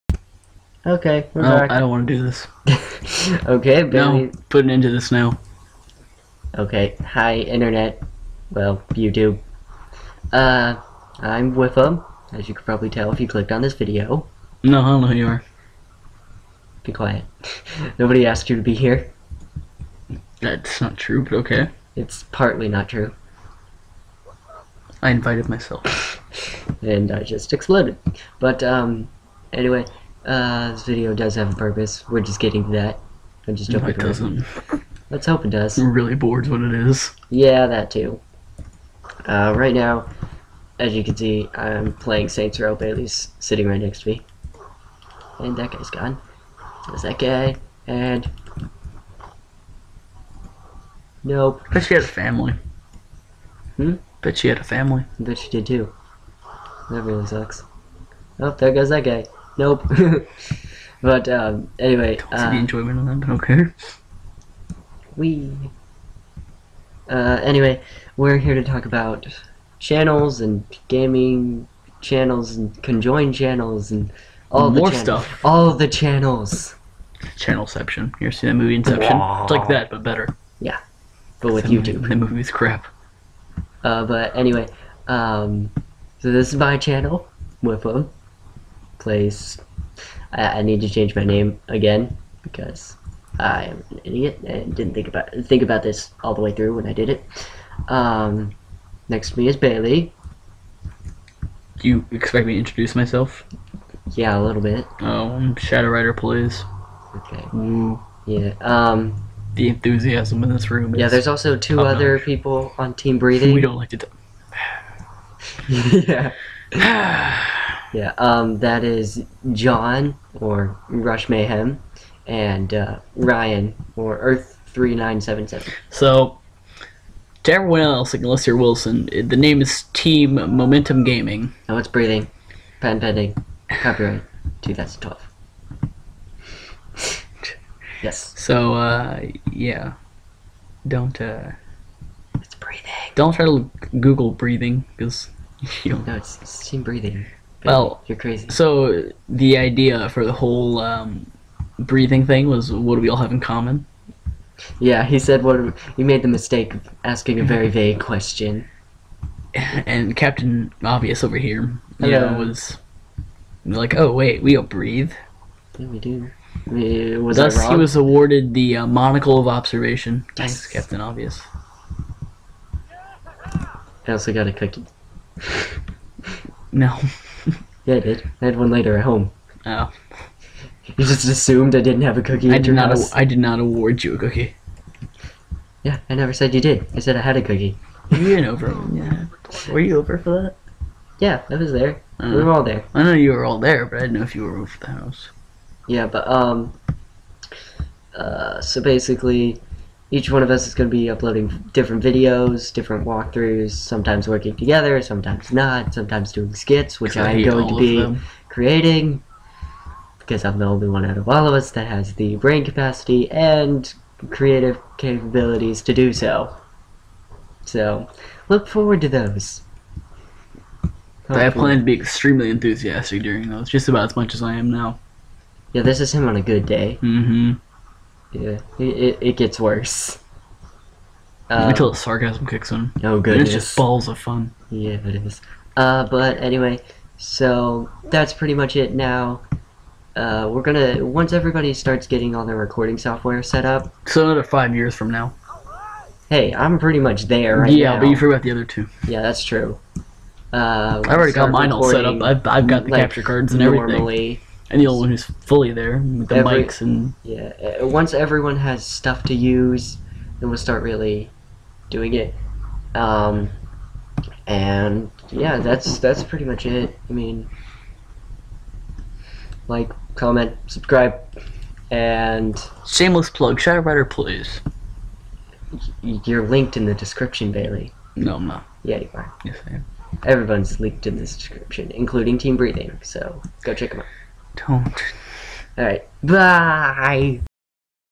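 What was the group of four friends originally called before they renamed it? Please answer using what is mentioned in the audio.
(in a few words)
Team Momentum Gaming.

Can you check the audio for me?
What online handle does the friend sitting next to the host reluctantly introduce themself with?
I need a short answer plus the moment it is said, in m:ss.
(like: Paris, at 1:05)
Shadow Rider, at 1:45.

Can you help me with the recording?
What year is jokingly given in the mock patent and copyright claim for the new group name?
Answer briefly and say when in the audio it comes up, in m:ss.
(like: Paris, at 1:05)
2012, at 2:14.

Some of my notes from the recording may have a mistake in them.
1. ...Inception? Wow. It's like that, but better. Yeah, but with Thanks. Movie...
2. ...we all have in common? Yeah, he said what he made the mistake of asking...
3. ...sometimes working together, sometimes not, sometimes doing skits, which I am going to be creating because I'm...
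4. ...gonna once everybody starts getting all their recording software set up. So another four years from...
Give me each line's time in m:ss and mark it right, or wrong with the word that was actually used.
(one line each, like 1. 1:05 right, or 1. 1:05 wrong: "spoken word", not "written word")
1. 1:18 wrong: "YouTube", not "Thanks"
2. 2:33 right
3. 3:23 right
4. 4:00 wrong: "five", not "four".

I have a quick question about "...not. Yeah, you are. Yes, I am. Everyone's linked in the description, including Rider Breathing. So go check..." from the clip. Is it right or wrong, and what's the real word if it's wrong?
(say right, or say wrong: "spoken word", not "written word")
wrong: "Team", not "Rider".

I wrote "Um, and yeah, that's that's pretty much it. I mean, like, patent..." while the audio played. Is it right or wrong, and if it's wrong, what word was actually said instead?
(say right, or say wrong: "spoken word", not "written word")
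wrong: "comment", not "patent".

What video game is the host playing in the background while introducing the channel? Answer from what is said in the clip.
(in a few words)
Saints Row.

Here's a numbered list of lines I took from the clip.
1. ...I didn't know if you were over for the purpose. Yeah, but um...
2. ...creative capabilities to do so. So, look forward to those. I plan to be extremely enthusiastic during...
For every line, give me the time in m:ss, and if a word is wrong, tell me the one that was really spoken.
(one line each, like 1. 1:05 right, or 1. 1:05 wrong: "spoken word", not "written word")
1. 3:13 wrong: "house", not "purpose"
2. 3:34 right.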